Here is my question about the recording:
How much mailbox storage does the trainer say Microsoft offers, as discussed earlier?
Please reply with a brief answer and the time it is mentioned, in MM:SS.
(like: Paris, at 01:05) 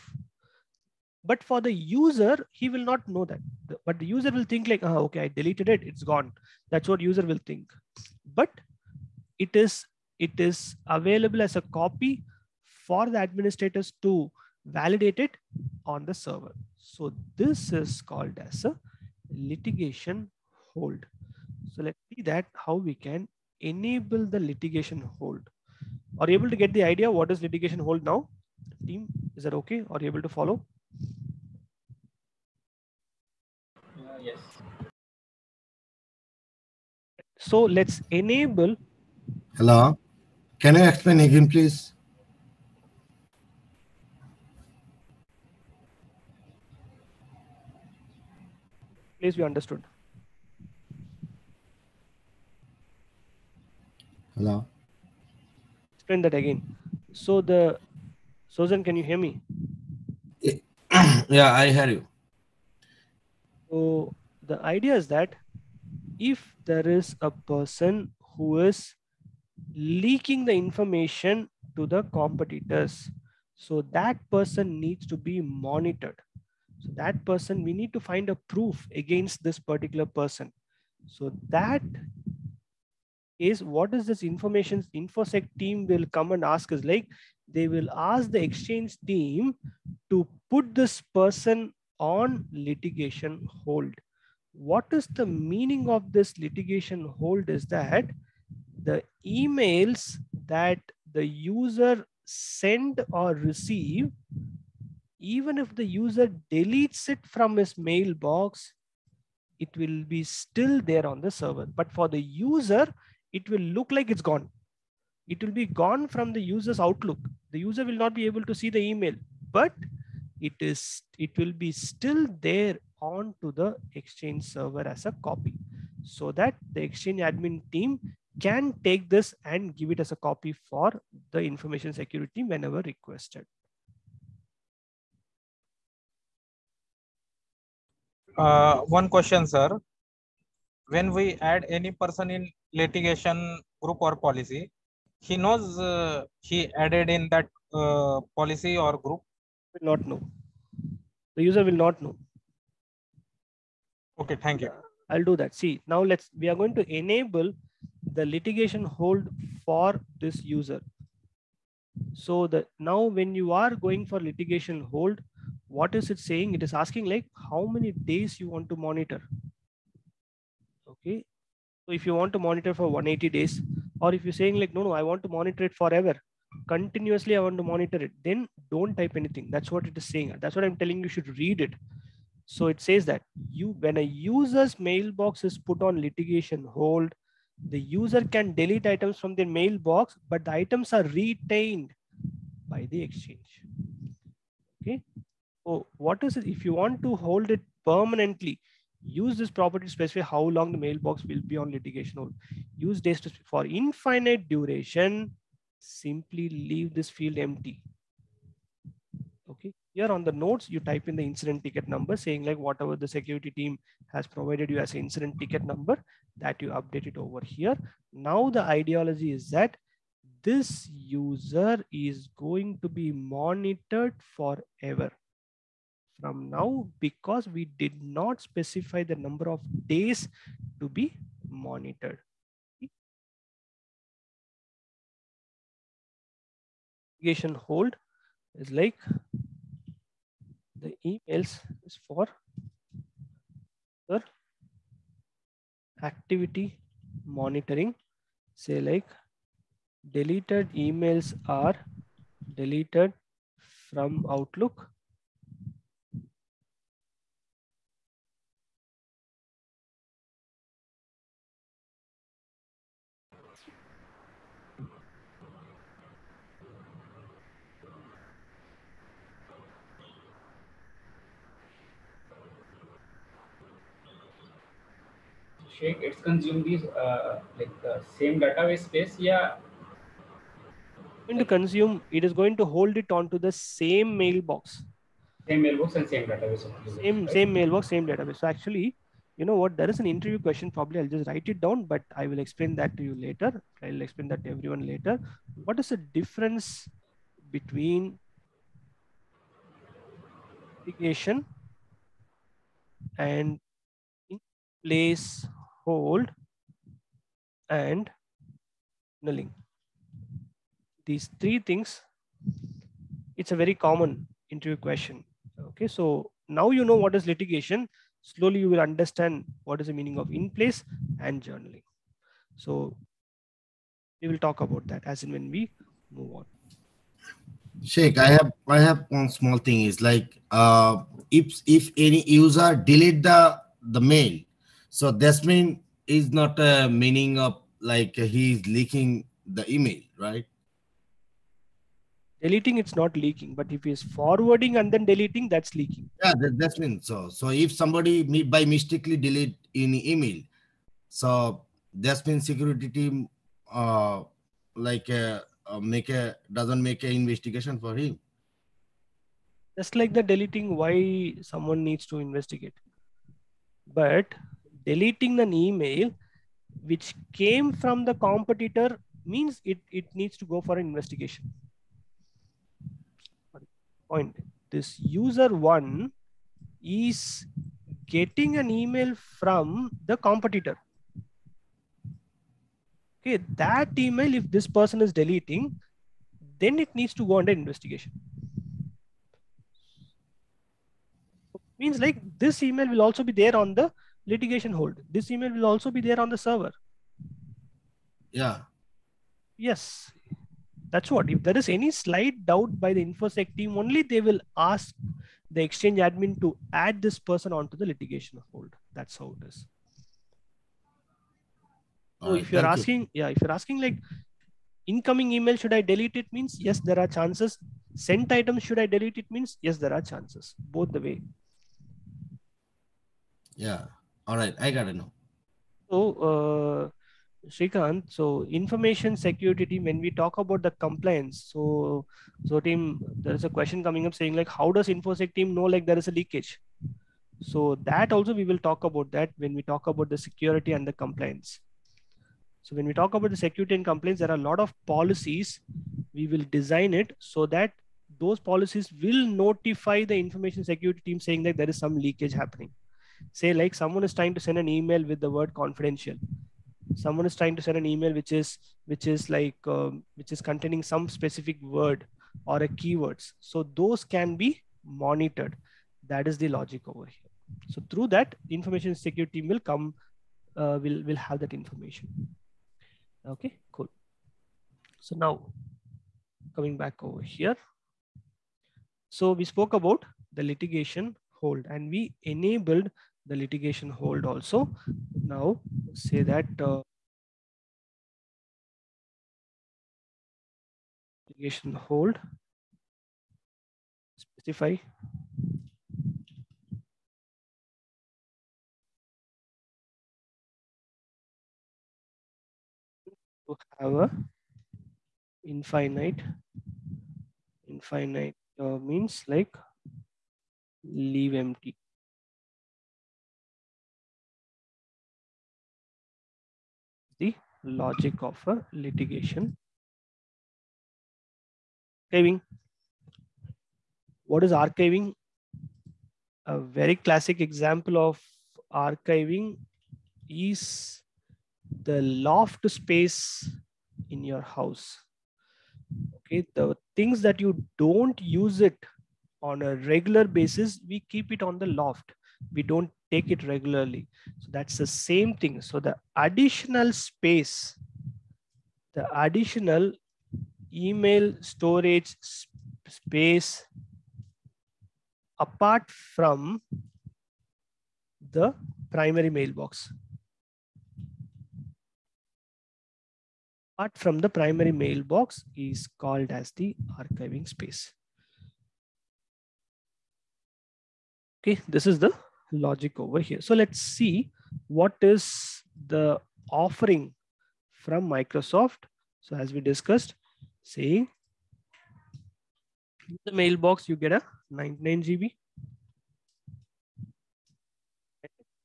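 99 GB, at 09:44.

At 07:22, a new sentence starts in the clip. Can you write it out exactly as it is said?
So when we talk about the security and compliance, there are a lot of policies.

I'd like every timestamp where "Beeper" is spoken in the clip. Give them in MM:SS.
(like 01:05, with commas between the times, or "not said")
not said.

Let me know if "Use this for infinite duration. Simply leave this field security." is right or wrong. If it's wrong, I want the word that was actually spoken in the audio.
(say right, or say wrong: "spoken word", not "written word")
wrong: "empty", not "security".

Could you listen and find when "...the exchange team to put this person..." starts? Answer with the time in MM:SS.
01:28.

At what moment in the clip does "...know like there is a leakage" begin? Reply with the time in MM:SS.
07:15.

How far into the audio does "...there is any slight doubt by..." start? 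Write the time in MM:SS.
06:41.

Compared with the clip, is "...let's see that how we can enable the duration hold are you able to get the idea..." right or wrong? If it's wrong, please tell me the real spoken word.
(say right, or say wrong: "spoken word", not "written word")
wrong: "litigation", not "duration".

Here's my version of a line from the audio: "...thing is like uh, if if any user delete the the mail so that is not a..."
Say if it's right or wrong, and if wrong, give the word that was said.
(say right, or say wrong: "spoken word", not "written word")
right.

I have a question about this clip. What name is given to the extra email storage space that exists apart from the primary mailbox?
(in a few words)
Archiving space.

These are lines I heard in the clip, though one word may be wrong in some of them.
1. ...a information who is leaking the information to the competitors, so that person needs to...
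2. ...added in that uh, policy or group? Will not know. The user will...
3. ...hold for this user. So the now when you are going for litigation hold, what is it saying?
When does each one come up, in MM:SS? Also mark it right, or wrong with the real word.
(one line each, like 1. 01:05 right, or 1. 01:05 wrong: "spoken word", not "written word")
1. 01:07 wrong: "person", not "information"
2. 02:26 right
3. 02:38 right.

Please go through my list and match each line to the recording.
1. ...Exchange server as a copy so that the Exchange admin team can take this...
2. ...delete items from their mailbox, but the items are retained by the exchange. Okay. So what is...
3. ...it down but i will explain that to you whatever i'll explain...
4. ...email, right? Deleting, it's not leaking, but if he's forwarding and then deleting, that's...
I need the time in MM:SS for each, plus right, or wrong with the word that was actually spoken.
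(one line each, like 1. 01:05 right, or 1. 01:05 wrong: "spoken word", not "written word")
1. 02:03 right
2. 03:08 right
3. 04:51 wrong: "later", not "whatever"
4. 05:39 right.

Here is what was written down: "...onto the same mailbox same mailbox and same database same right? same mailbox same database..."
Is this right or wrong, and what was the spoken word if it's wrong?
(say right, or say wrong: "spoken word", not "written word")
right.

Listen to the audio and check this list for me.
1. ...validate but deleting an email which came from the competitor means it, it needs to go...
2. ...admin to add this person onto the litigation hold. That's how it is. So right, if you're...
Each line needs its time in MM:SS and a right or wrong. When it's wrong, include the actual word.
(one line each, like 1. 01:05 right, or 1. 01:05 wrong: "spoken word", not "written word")
1. 06:02 wrong: "investigate", not "validate"
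2. 06:46 right.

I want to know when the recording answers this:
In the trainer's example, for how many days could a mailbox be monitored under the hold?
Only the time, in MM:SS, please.
02:52.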